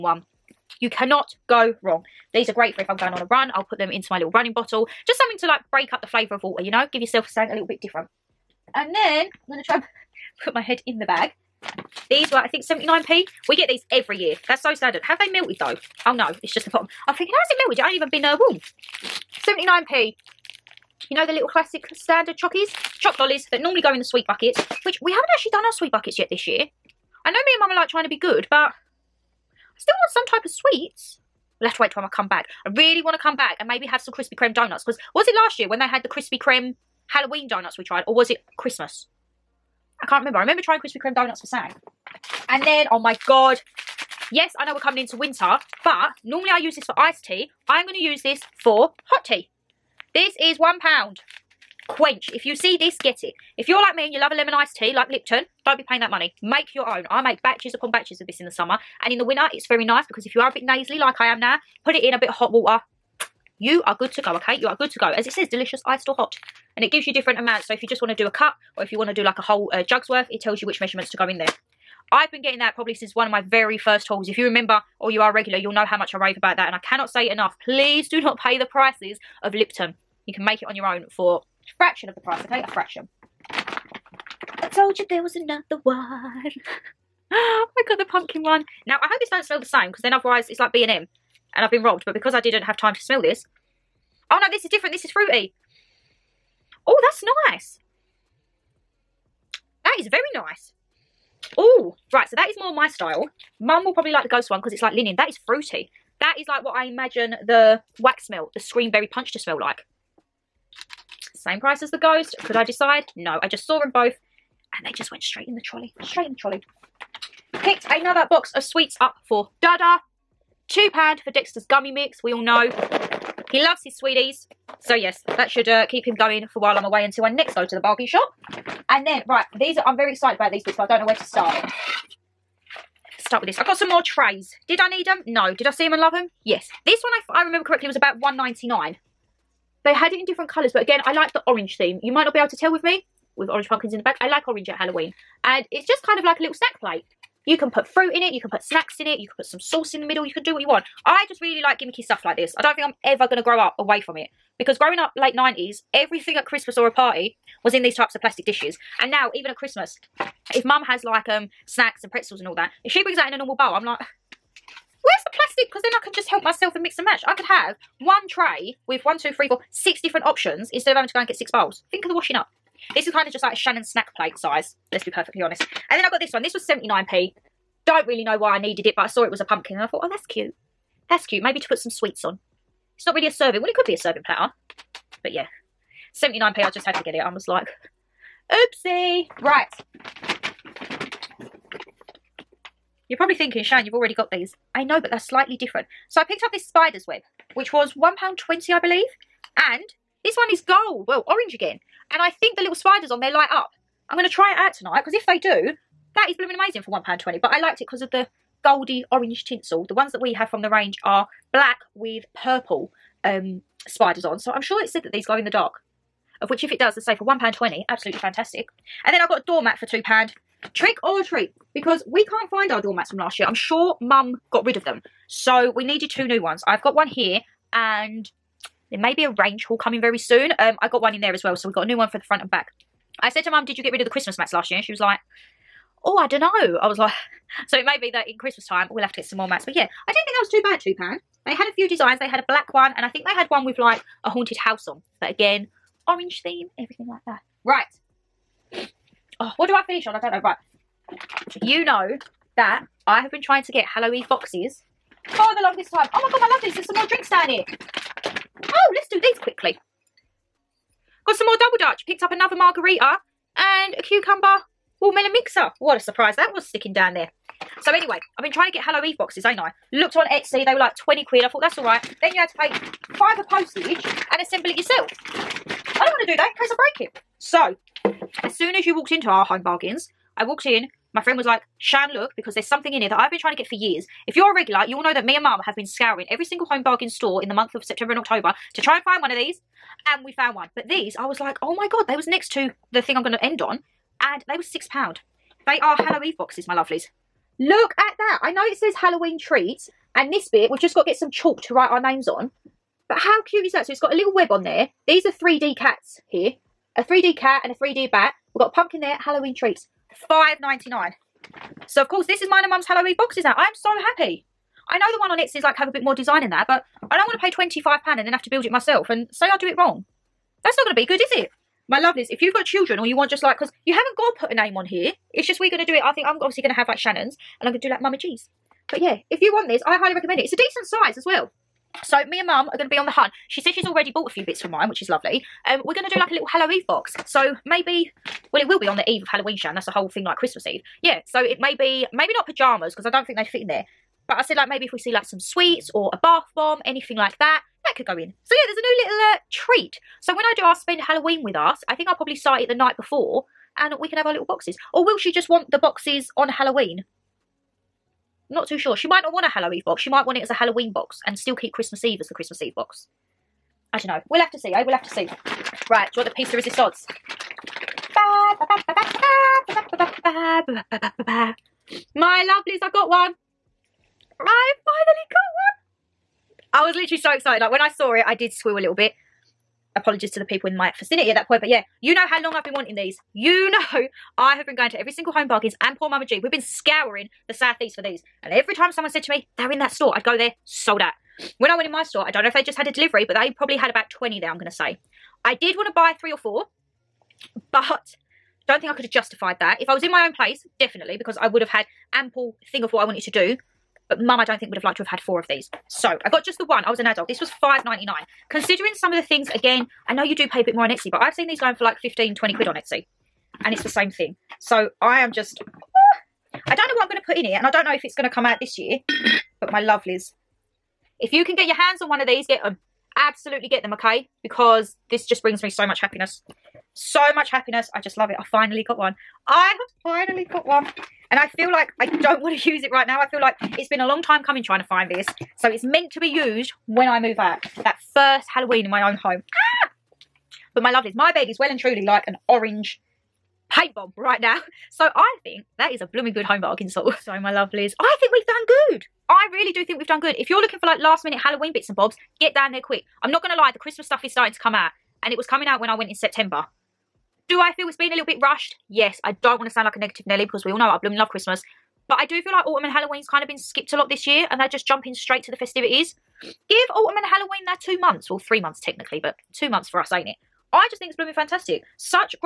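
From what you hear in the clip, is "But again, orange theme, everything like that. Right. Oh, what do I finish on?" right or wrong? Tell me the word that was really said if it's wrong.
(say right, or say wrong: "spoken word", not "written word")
right.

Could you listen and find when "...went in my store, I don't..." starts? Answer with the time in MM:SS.
06:31.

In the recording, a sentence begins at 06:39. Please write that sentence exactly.
If I was in my own place, definitely, because I would have had ample thing of what I wanted to do.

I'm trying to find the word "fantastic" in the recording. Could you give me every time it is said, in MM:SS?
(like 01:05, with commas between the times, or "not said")
03:38, 07:51.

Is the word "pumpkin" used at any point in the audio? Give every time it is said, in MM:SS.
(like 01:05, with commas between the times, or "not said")
01:28, 02:23, 02:59, 05:08.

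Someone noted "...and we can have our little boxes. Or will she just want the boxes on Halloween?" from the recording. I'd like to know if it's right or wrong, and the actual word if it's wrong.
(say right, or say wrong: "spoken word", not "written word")
right.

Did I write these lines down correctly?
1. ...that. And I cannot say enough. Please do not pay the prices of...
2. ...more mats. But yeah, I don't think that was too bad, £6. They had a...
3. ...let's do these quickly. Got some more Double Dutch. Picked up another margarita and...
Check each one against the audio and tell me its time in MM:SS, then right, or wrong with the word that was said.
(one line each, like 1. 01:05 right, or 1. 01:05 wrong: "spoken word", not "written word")
1. 01:16 right
2. 03:59 wrong: "2", not "6"
3. 04:18 right.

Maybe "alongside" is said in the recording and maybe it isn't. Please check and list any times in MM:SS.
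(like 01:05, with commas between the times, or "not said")
not said.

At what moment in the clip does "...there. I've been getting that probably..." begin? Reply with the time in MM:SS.
01:11.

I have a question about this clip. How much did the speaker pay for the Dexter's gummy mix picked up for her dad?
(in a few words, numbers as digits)
£2.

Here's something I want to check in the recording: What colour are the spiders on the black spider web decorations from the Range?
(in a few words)
Purple.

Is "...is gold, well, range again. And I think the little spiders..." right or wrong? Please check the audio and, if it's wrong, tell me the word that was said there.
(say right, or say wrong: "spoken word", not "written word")
wrong: "orange", not "range".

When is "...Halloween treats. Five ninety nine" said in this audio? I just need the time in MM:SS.
05:09.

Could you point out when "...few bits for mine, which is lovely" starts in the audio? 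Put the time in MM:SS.
05:34.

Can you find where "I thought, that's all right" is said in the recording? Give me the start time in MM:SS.
04:31.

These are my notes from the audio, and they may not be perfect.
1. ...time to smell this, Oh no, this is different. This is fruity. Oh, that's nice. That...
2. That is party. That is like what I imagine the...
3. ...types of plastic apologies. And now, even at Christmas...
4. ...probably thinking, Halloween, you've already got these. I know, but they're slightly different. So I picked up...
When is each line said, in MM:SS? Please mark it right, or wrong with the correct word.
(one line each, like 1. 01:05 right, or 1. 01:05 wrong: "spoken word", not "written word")
1. 01:32 right
2. 01:45 wrong: "fruity", not "party"
3. 02:37 wrong: "dishes", not "apologies"
4. 03:13 wrong: "Shan", not "Halloween".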